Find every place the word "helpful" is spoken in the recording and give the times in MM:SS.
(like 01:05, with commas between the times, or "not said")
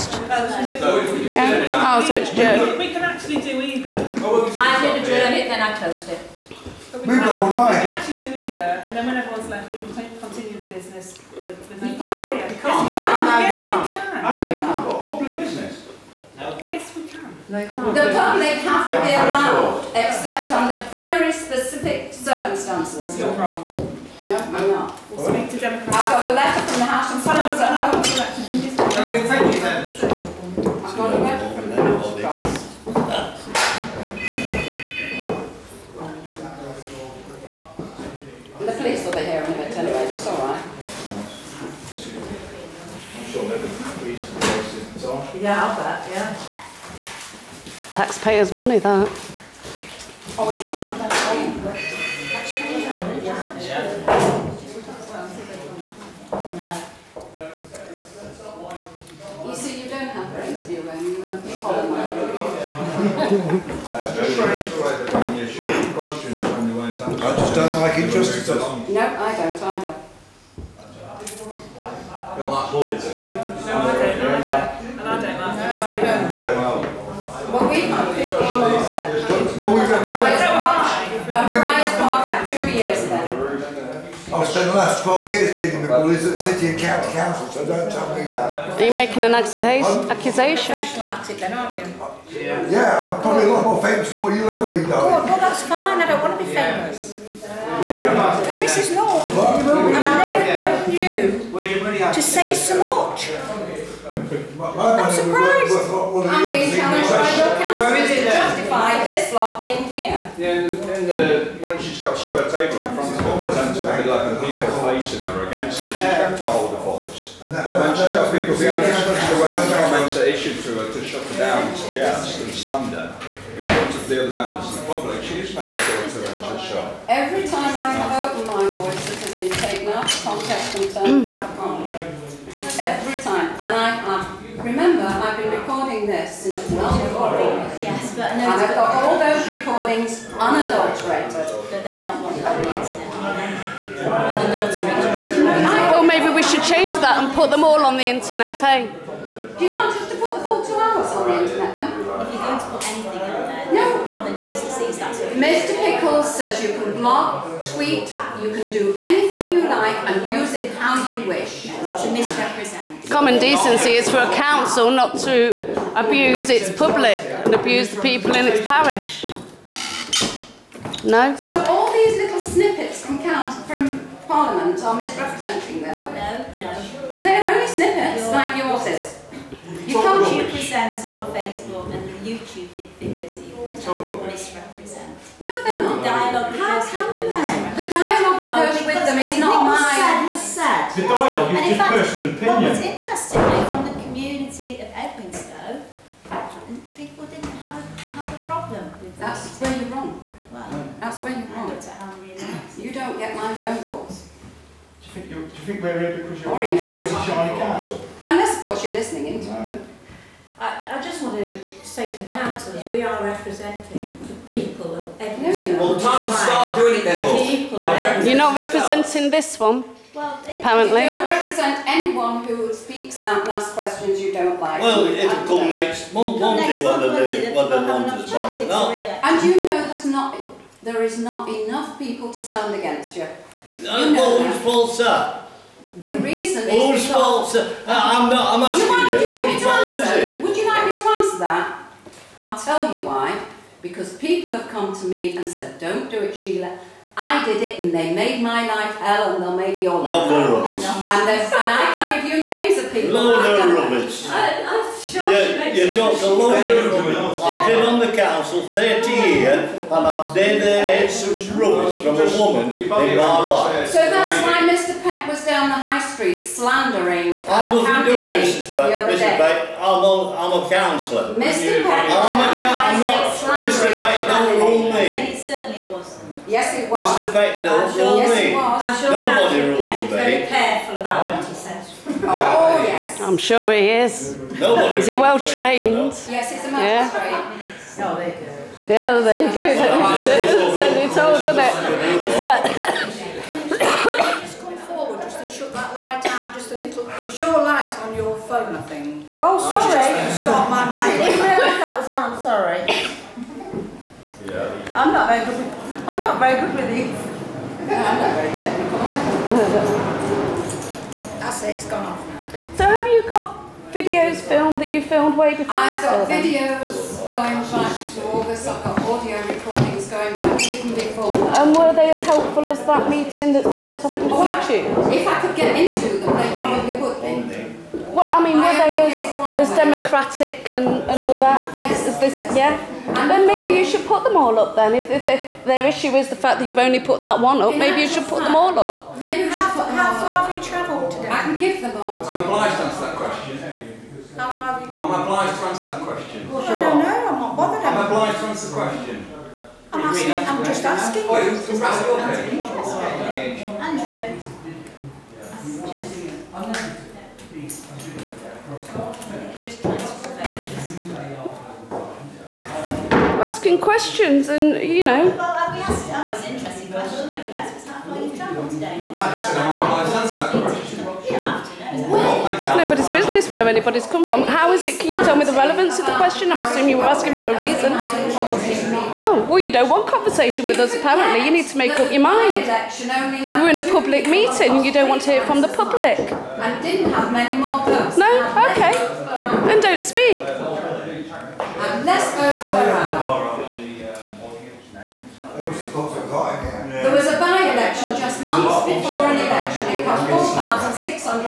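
05:22.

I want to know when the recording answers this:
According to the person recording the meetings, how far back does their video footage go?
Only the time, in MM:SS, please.
05:18.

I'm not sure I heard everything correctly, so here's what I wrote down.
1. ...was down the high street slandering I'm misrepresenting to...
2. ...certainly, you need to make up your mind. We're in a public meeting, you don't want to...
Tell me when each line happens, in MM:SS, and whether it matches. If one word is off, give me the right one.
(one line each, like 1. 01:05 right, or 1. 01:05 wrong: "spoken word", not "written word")
1. 04:25 wrong: "nothing", not "misrepresenting"
2. 06:20 wrong: "apparently", not "certainly".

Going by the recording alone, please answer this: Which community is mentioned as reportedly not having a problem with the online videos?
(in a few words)
Edwinstowe.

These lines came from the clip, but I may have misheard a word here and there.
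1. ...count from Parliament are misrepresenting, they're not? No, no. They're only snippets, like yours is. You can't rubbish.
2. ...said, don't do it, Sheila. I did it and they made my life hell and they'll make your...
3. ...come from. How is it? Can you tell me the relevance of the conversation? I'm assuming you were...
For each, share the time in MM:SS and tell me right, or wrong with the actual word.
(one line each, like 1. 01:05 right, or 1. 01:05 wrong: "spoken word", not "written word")
1. 02:53 right
2. 04:05 right
3. 06:14 wrong: "question", not "conversation".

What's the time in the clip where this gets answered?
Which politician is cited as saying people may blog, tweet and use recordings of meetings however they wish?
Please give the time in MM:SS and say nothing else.
02:35.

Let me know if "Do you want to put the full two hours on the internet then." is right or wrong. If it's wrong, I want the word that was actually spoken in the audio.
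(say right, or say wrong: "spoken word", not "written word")
right.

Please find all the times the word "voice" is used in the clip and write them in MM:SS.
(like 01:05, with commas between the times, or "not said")
01:56, 02:08.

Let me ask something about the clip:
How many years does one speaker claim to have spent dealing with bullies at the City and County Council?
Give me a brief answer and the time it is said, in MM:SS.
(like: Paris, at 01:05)
12, at 01:25.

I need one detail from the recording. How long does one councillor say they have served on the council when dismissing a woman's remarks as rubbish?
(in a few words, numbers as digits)
30 years.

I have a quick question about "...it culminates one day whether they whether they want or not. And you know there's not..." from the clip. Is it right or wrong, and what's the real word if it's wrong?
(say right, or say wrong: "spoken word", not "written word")
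right.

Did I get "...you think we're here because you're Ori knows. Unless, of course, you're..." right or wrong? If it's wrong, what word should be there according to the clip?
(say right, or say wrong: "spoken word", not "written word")
right.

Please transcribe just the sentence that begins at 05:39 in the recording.
Maybe how, how far have you travelled today?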